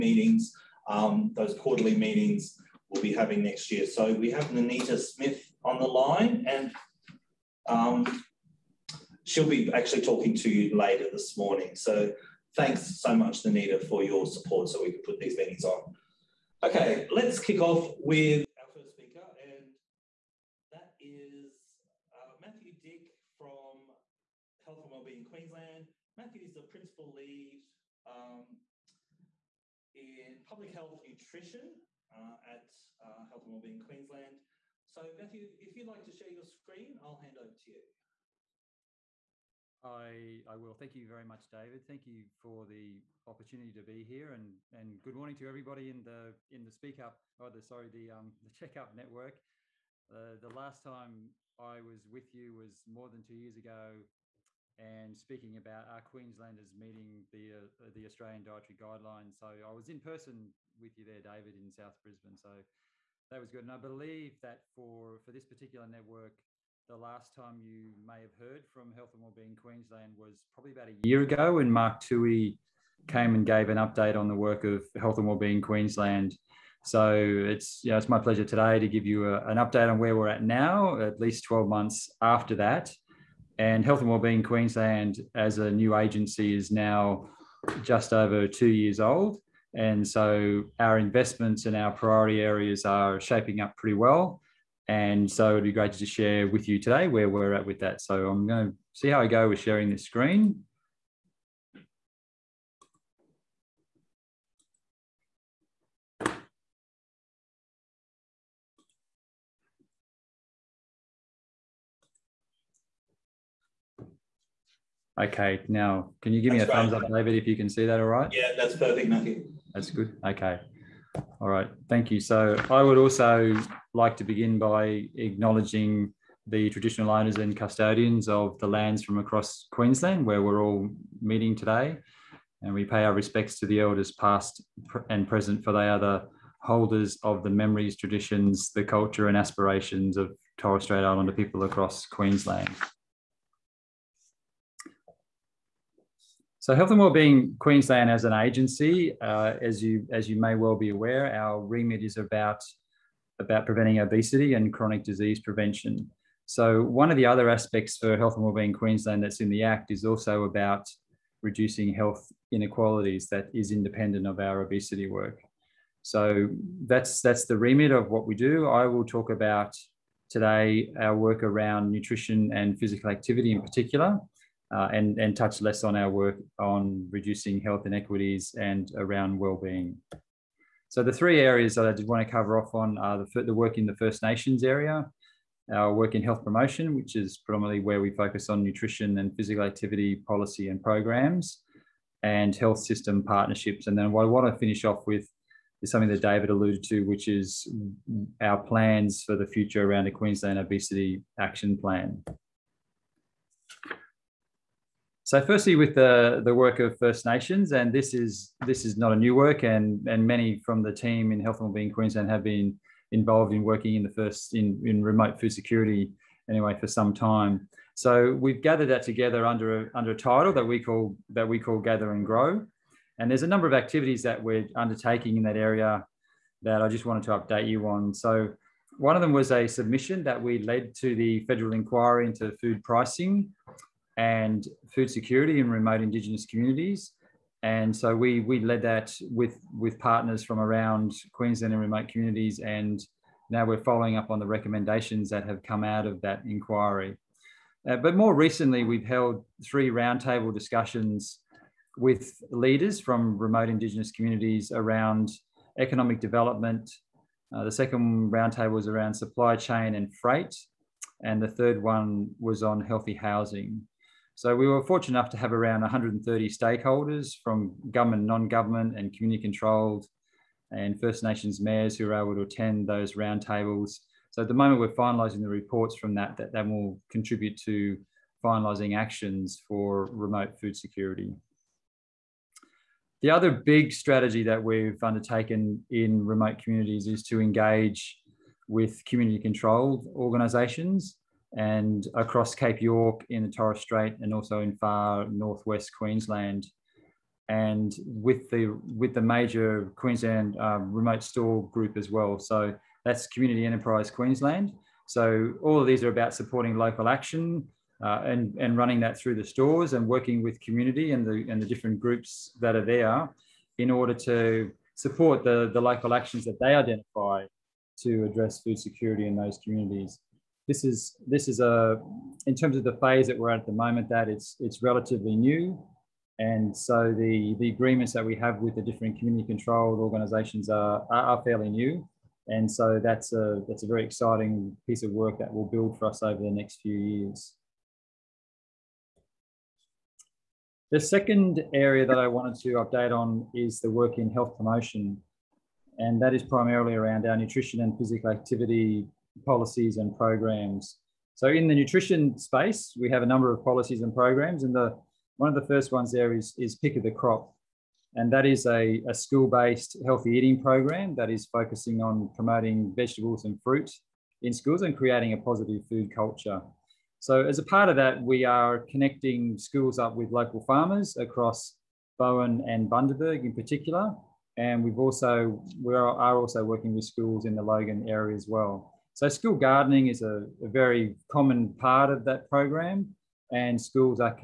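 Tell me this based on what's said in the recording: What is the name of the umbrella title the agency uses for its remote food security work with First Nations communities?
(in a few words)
Gather and Grow.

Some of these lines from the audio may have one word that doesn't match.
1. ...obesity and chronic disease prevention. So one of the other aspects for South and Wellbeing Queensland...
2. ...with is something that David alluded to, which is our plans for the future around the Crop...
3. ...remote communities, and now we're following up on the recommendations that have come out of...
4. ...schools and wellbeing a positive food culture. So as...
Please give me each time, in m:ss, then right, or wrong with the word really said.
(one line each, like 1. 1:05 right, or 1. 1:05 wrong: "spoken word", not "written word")
1. 2:34 wrong: "Health", not "South"
2. 3:15 wrong: "Queensland", not "Crop"
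3. 4:01 right
4. 6:04 wrong: "creating", not "wellbeing".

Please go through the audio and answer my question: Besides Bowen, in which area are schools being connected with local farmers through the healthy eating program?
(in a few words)
Bundaberg.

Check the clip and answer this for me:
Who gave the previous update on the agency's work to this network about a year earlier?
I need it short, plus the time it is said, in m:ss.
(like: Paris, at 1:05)
Mark Tui, at 1:11.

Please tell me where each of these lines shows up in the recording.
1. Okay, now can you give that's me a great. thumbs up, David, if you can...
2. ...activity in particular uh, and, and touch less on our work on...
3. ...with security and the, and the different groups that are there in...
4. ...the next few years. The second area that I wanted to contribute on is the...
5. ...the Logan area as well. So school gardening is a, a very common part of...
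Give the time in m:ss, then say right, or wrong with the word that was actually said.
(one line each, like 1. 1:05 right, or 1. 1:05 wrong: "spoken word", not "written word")
1. 1:55 right
2. 2:53 right
3. 5:10 wrong: "community", not "security"
4. 5:36 wrong: "update", not "contribute"
5. 6:17 right.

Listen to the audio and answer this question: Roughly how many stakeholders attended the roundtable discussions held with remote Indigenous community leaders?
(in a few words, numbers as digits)
130.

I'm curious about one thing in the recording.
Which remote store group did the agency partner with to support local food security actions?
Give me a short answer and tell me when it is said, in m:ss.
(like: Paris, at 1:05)
Community Enterprise Queensland, at 5:03.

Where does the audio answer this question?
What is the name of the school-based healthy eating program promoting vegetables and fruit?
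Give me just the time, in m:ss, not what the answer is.
5:56.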